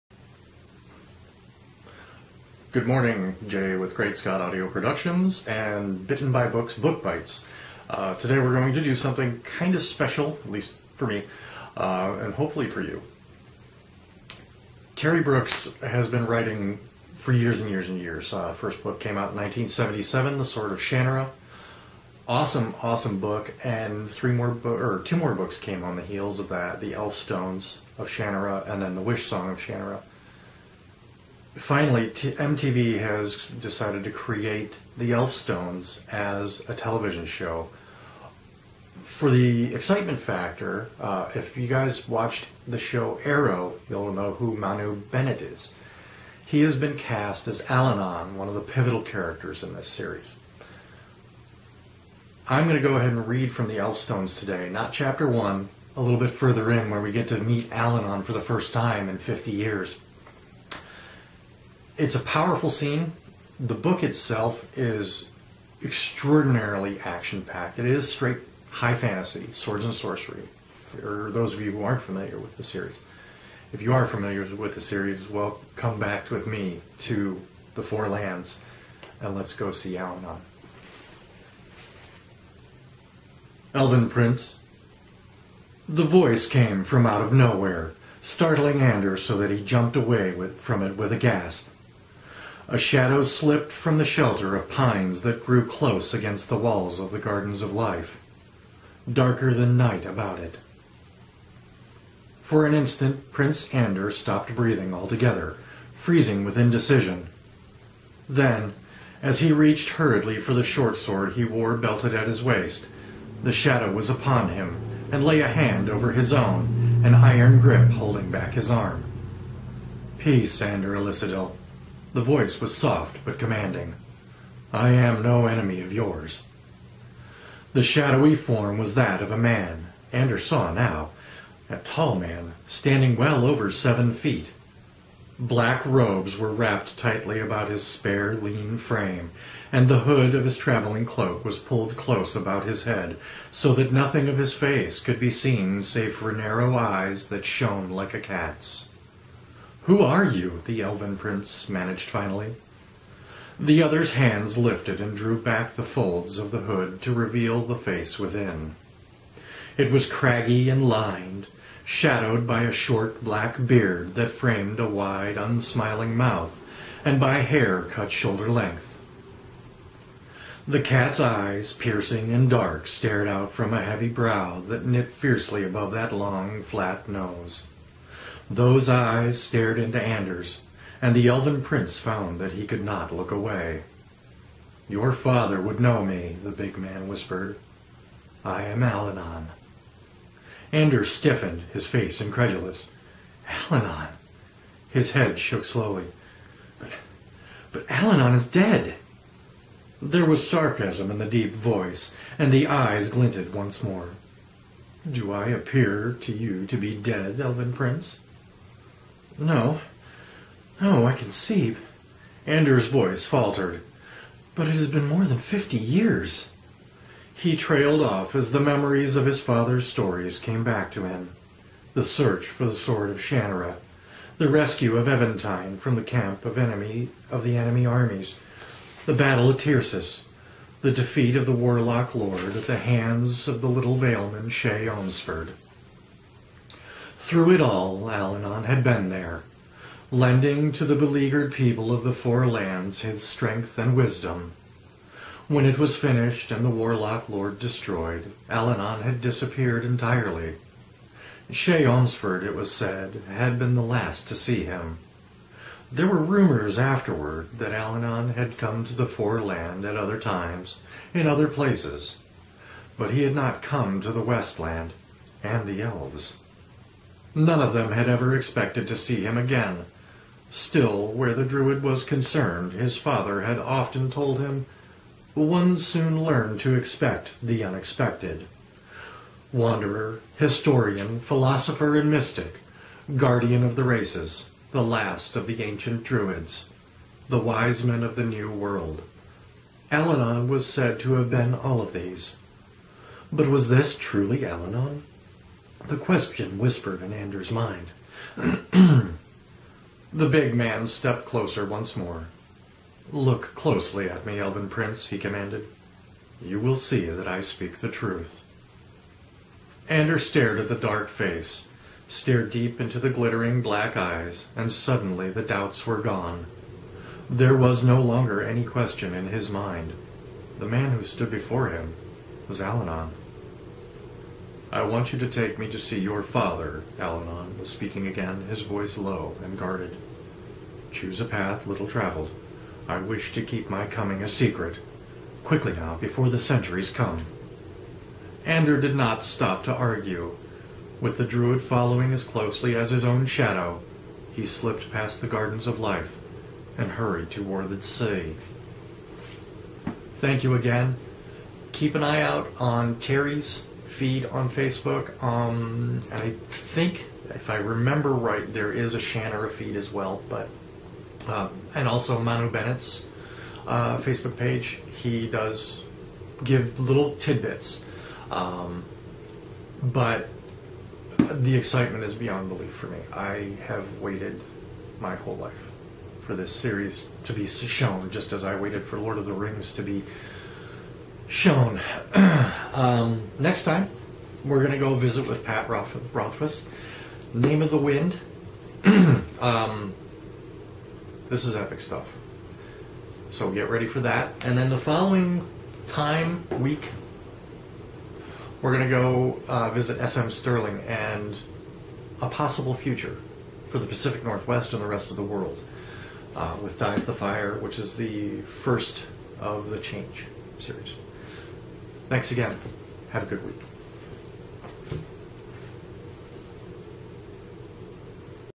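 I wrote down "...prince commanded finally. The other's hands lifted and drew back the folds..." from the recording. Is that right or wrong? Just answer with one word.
wrong.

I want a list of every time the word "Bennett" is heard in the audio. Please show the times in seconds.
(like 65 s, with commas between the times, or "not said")
44 s, 362 s.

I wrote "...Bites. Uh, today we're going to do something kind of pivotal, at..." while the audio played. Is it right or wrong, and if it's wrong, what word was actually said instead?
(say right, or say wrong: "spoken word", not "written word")
wrong: "special", not "pivotal".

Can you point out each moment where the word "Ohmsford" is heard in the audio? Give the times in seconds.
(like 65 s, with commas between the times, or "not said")
234 s, 251 s.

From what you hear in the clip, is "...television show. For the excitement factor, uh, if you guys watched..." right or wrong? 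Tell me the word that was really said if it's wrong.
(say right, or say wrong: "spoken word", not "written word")
right.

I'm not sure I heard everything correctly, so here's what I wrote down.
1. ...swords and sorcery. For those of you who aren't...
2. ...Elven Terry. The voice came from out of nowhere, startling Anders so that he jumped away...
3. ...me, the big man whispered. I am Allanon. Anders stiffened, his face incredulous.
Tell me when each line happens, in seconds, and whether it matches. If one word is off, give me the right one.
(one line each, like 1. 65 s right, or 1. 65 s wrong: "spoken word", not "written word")
1. 69 s right
2. 83 s wrong: "Prince", not "Terry"
3. 186 s right.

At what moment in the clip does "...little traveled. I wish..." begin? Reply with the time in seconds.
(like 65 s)
331 s.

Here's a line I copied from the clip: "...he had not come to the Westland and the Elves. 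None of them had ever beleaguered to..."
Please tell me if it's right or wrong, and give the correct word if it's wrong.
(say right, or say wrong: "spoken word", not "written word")
wrong: "expected", not "beleaguered".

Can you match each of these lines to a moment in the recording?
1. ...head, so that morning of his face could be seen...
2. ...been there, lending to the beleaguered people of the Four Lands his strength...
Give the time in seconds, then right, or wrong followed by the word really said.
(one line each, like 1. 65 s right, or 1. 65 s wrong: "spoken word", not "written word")
1. 142 s wrong: "nothing", not "morning"
2. 238 s right.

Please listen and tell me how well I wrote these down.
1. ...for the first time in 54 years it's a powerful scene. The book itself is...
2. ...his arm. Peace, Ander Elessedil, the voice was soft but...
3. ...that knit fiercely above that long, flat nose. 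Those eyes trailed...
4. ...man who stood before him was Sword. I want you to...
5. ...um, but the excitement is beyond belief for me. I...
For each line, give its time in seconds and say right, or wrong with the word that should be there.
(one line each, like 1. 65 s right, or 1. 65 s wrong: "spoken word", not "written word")
1. 58 s wrong: "50", not "54"
2. 118 s right
3. 174 s wrong: "stared", not "trailed"
4. 320 s wrong: "Alanon", not "Sword"
5. 368 s right.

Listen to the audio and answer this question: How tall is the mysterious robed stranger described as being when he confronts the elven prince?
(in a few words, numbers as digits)
over seven feet.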